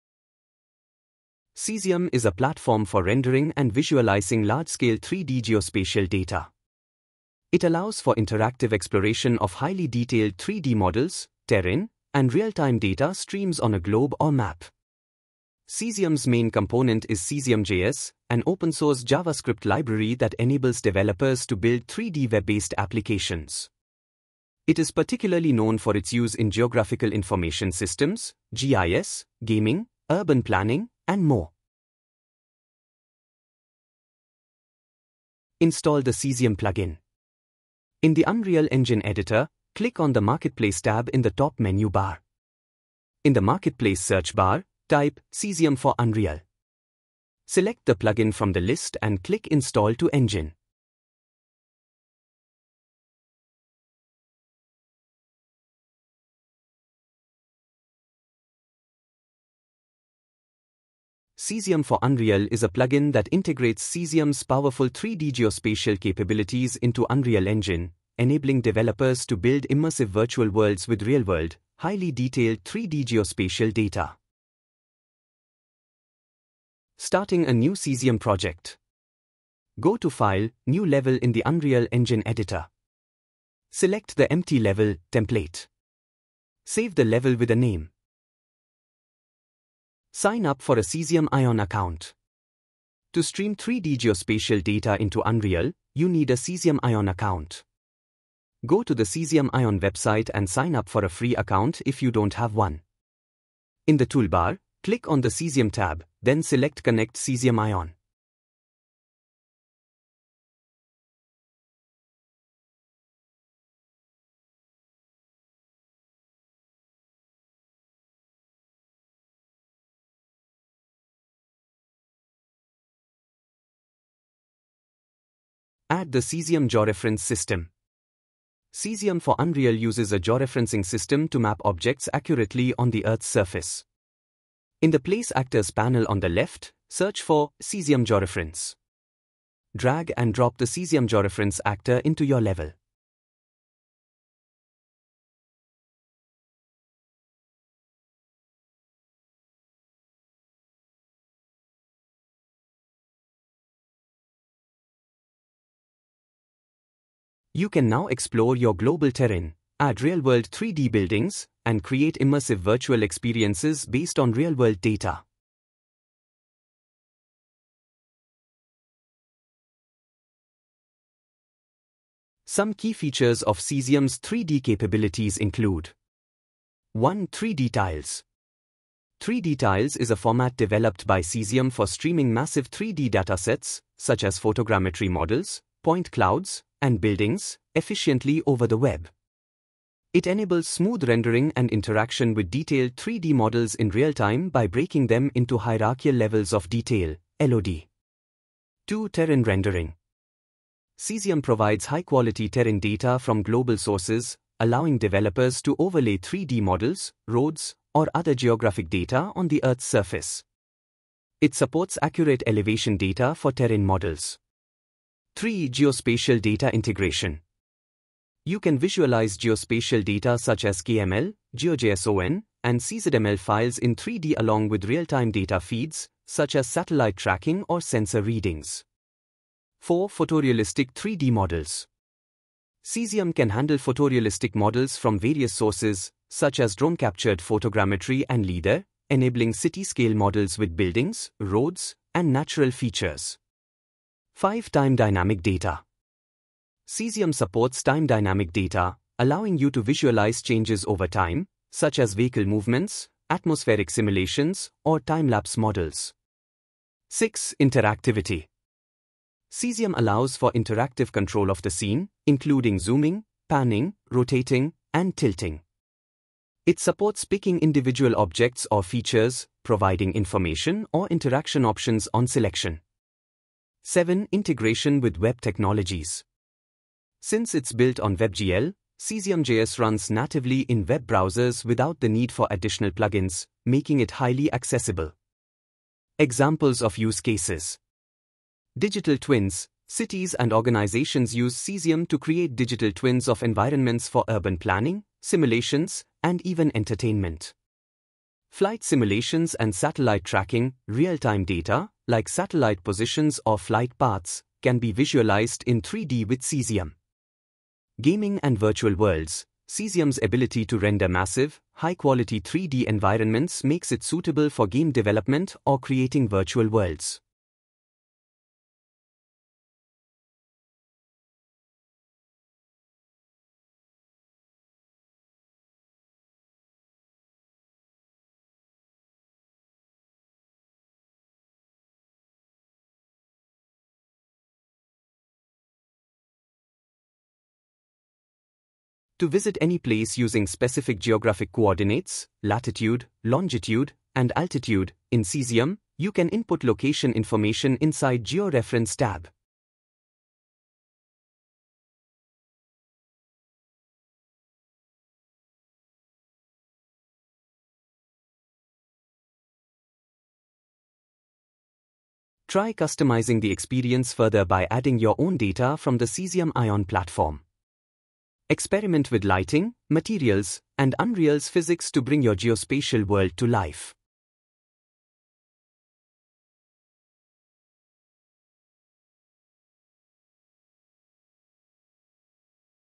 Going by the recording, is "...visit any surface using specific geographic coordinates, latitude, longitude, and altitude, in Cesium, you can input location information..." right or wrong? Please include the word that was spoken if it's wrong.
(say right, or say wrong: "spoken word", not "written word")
wrong: "place", not "surface".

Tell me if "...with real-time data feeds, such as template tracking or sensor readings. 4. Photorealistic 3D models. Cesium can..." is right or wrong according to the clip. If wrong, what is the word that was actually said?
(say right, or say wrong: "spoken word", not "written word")
wrong: "satellite", not "template".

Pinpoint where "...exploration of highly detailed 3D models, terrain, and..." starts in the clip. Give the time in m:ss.
0:08.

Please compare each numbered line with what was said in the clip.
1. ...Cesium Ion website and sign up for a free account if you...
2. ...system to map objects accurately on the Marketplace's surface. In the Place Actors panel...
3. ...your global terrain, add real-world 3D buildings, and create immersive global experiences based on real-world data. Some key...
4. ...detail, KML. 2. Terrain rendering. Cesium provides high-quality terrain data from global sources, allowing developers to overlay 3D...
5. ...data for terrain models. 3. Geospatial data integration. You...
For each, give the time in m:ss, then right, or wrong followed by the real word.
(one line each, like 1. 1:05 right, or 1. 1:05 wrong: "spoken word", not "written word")
1. 1:39 right
2. 2:10 wrong: "Earth", not "Marketplace"
3. 2:38 wrong: "virtual", not "global"
4. 3:16 wrong: "LOD", not "KML"
5. 3:32 right.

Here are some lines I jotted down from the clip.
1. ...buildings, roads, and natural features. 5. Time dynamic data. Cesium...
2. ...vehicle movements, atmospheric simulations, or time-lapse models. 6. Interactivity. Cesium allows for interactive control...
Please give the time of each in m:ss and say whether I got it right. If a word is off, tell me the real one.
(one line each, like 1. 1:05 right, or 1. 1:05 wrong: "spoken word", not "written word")
1. 4:00 right
2. 4:12 right.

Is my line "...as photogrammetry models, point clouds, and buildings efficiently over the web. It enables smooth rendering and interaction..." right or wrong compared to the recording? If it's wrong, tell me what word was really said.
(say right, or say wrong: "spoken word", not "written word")
right.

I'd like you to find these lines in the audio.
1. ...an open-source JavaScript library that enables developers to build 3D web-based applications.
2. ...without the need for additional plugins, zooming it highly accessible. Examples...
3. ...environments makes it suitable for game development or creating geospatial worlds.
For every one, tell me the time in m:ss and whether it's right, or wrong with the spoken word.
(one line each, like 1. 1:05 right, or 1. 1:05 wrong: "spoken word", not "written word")
1. 0:18 right
2. 4:41 wrong: "making", not "zooming"
3. 5:12 wrong: "virtual", not "geospatial".